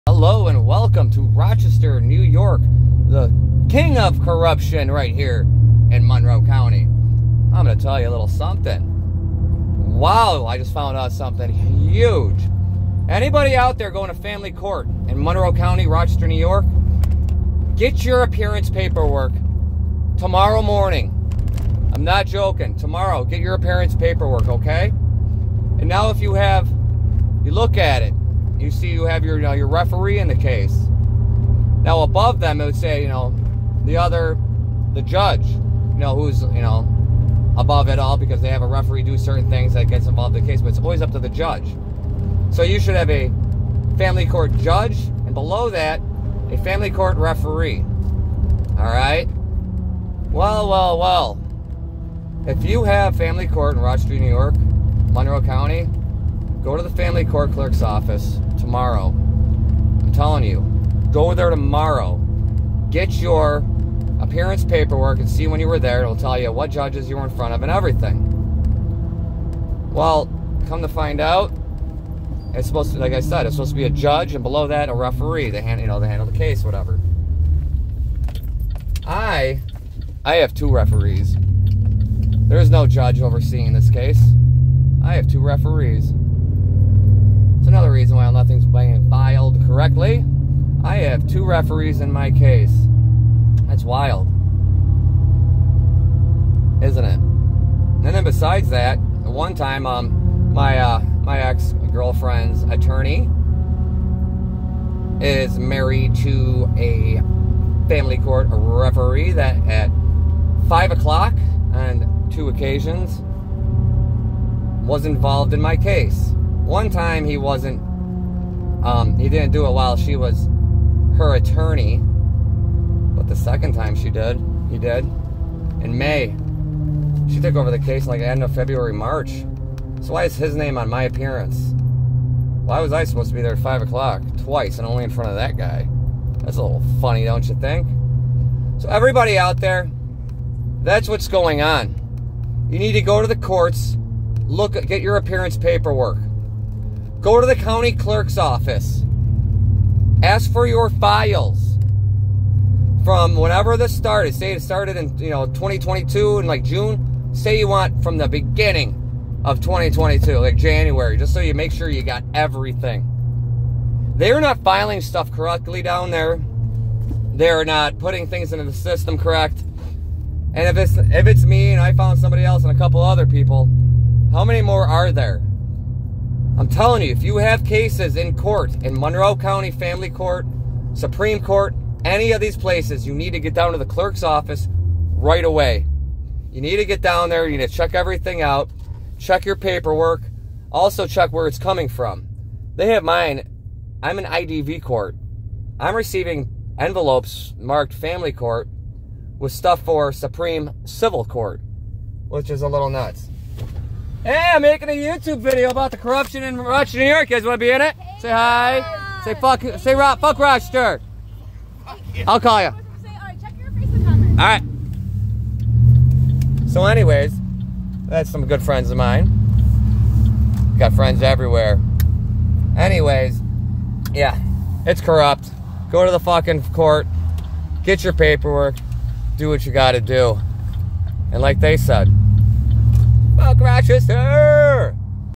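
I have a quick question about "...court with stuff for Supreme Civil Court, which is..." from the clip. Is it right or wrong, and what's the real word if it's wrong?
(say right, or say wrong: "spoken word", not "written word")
right.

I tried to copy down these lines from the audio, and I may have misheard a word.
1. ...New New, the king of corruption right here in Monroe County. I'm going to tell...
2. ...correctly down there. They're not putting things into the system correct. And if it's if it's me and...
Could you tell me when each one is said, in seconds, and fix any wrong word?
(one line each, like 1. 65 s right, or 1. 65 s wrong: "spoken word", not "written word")
1. 1 s wrong: "York", not "New"
2. 165 s right.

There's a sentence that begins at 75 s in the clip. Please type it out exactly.
They hand, you know, they handle the case, whatever.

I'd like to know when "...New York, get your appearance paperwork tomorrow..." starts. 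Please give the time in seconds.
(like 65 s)
16 s.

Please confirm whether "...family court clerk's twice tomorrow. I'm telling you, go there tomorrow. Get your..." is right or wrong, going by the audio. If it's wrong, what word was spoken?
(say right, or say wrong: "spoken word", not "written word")
wrong: "office", not "twice".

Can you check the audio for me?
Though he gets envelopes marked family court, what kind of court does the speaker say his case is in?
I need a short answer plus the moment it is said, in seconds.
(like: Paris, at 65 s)
IDV court, at 194 s.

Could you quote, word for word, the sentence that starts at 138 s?
So, everybody out there, that's what's going on.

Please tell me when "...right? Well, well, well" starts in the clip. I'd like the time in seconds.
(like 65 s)
48 s.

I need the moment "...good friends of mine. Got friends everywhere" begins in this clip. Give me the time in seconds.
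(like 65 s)
218 s.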